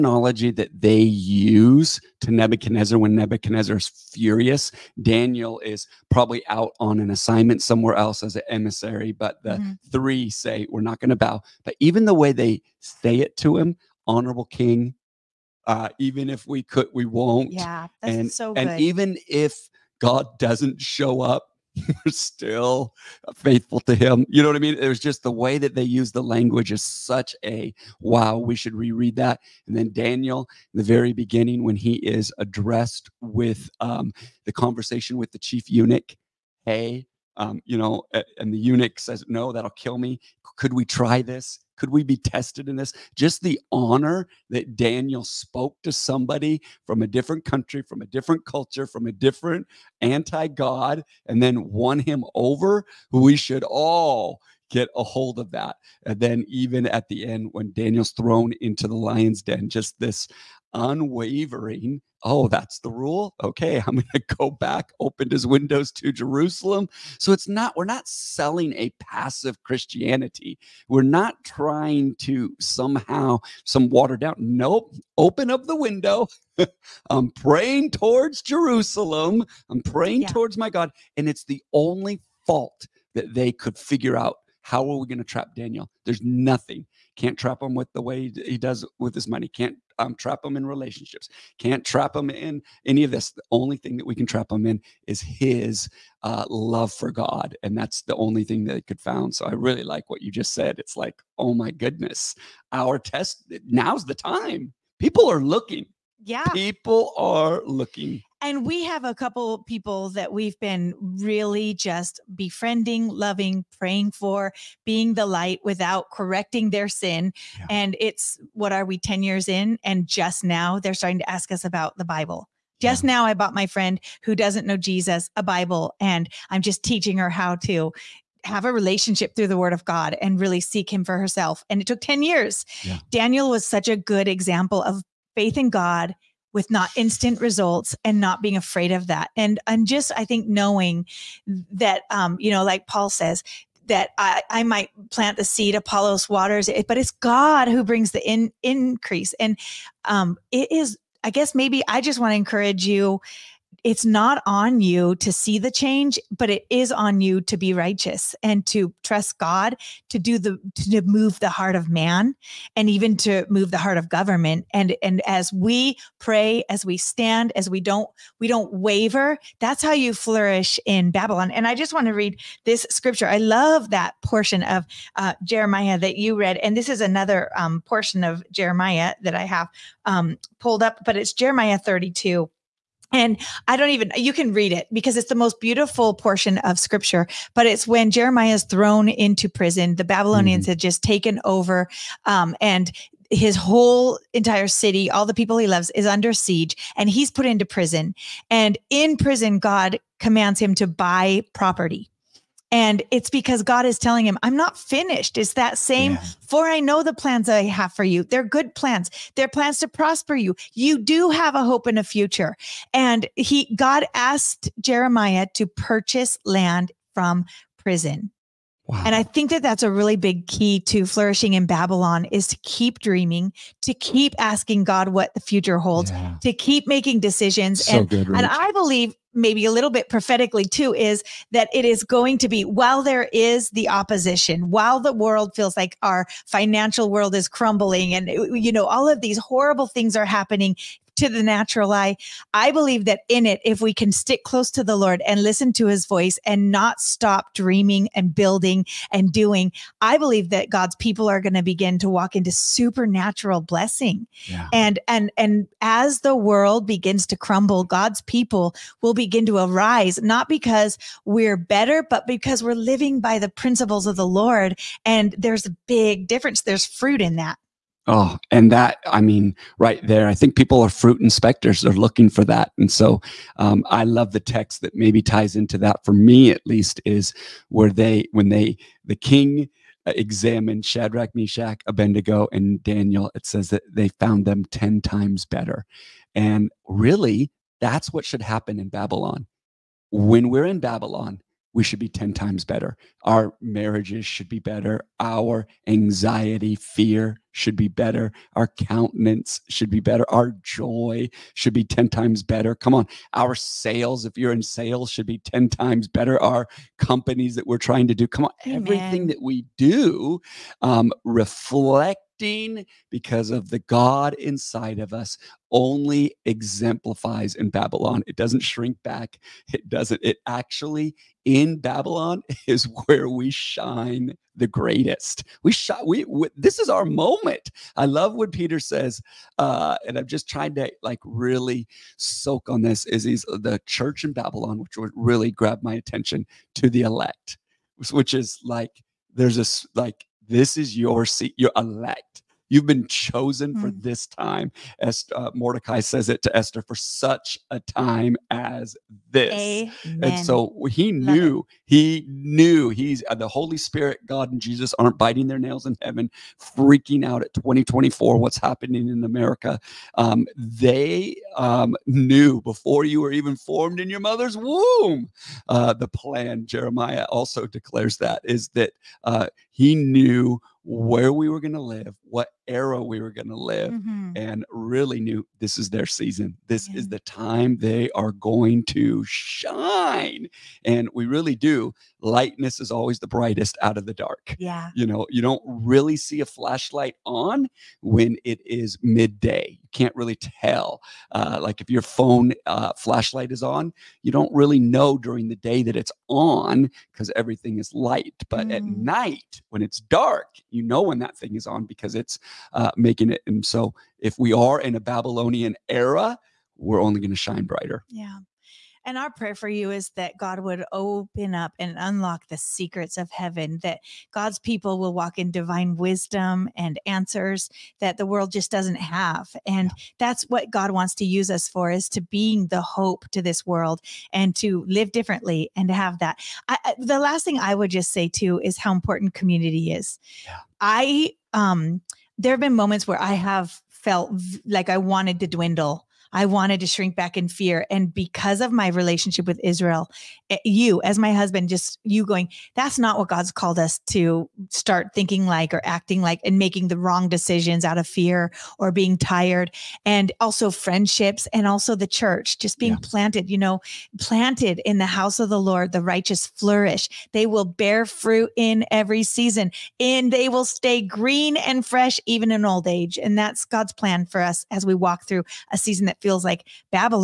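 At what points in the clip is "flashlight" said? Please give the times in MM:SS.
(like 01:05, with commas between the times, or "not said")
06:26, 06:32.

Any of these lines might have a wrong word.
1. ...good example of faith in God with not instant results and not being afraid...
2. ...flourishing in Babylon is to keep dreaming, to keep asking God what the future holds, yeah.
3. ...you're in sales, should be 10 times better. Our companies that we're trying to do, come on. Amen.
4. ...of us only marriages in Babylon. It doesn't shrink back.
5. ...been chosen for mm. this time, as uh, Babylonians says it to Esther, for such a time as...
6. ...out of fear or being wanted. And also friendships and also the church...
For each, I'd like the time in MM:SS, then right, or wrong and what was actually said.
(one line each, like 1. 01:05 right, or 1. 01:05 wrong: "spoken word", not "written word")
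1. 02:13 right
2. 03:41 right
3. 05:04 right
4. 05:14 wrong: "exemplifies", not "marriages"
5. 05:42 wrong: "Mordecai", not "Babylonians"
6. 07:27 wrong: "tired", not "wanted".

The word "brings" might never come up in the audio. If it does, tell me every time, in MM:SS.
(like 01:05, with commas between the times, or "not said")
02:27.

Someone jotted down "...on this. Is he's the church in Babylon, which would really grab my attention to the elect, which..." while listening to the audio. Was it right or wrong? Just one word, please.
right.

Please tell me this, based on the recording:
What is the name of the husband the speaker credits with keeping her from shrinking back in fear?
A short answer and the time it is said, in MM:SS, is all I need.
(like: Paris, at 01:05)
Israel, at 07:19.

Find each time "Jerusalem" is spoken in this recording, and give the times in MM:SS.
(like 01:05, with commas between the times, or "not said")
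01:06, 01:18.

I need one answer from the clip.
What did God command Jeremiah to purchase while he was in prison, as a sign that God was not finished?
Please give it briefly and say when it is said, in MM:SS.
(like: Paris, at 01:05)
Land, at 03:36.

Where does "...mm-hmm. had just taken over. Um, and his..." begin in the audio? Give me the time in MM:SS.
03:10.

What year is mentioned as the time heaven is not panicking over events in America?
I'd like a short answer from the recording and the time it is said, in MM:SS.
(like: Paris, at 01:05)
2024, at 05:57.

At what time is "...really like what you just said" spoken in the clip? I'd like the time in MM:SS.
01:39.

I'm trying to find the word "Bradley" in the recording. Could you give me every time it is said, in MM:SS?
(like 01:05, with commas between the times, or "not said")
not said.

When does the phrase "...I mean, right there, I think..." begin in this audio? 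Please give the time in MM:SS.
04:29.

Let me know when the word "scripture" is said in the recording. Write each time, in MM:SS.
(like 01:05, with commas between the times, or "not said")
02:52, 03:06.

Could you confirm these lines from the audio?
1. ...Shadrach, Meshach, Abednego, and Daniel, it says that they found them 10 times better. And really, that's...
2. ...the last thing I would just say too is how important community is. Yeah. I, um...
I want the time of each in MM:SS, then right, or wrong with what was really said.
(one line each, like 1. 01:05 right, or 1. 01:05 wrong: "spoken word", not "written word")
1. 04:40 right
2. 07:06 right.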